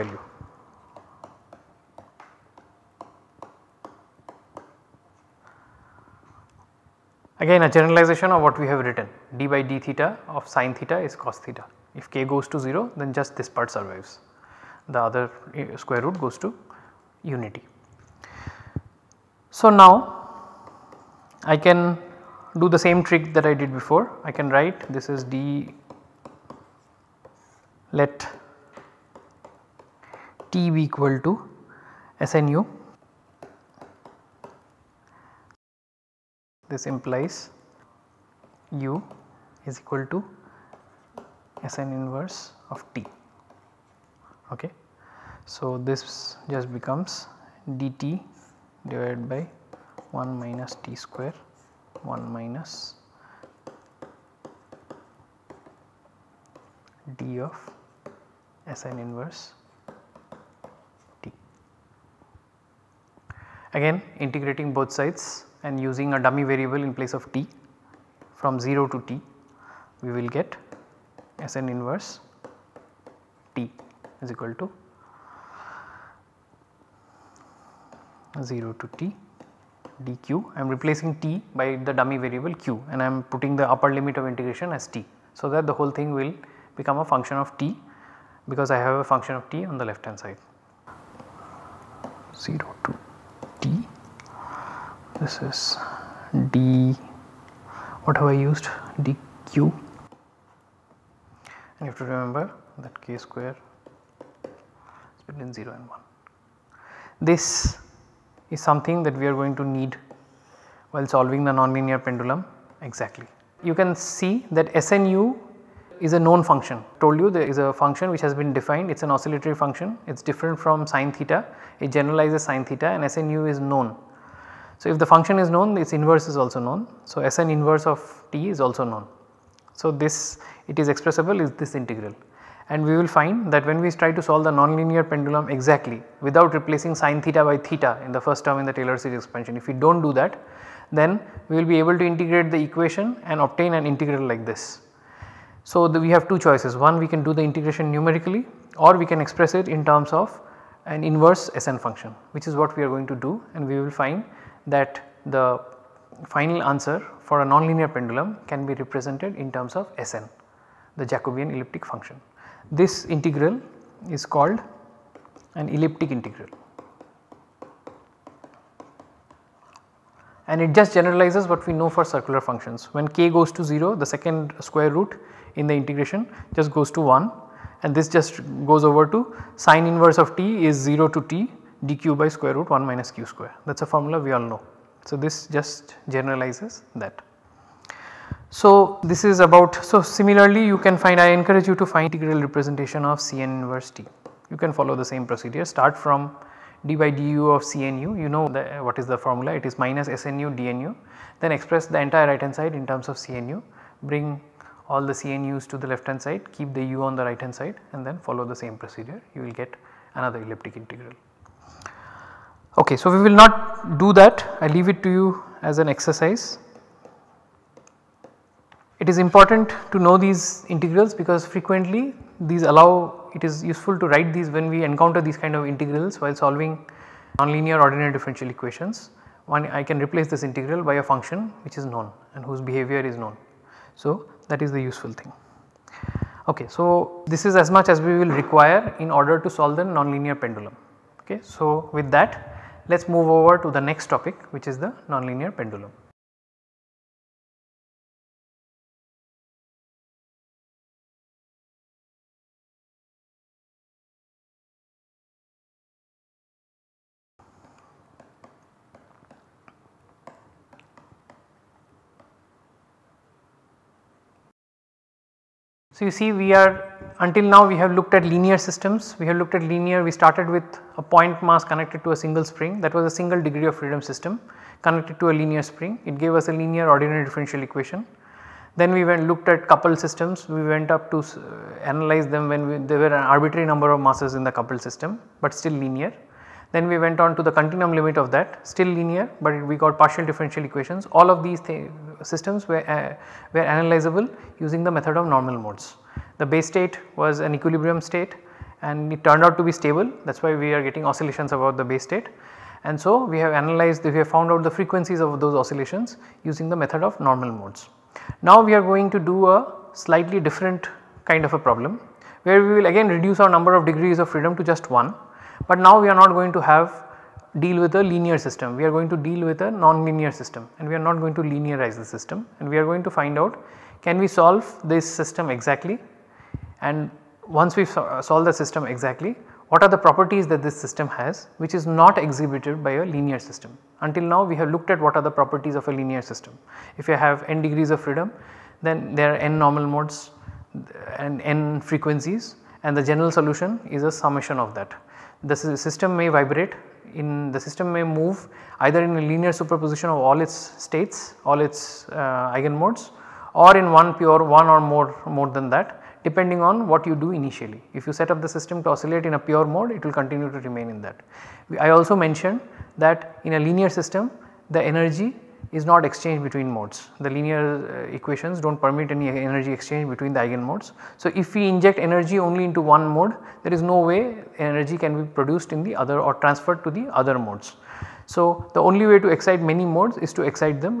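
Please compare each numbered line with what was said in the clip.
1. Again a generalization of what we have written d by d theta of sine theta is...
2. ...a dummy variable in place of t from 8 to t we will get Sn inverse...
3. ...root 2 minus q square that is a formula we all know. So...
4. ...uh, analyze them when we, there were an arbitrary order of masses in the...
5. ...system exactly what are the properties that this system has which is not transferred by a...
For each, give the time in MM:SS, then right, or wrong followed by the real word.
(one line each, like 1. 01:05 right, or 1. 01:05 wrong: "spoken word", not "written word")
1. 00:07 right
2. 01:06 wrong: "0", not "8"
3. 03:02 wrong: "1", not "2"
4. 04:41 wrong: "number", not "order"
5. 05:28 wrong: "exhibited", not "transferred".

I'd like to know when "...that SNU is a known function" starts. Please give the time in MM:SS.
01:54.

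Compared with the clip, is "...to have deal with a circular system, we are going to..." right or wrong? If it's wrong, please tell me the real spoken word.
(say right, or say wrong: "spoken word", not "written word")
wrong: "linear", not "circular".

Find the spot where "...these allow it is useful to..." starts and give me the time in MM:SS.
03:42.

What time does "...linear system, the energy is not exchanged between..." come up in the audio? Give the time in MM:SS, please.
06:03.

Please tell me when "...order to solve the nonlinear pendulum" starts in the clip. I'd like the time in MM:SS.
03:59.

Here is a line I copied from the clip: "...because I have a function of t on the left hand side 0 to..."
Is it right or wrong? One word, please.
right.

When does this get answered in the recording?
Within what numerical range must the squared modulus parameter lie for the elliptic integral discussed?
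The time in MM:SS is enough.
01:45.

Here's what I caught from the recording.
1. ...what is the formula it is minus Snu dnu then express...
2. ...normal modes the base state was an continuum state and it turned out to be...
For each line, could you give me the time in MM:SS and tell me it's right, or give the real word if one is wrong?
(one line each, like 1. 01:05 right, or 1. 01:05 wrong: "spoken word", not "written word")
1. 03:18 right
2. 04:55 wrong: "equilibrium", not "continuum".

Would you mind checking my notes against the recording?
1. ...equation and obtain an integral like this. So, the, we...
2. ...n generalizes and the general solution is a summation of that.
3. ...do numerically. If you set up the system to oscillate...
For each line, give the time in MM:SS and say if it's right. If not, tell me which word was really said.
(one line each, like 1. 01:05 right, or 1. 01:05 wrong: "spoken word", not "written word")
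1. 02:22 right
2. 05:41 wrong: "frequencies", not "generalizes"
3. 05:57 wrong: "initially", not "numerically".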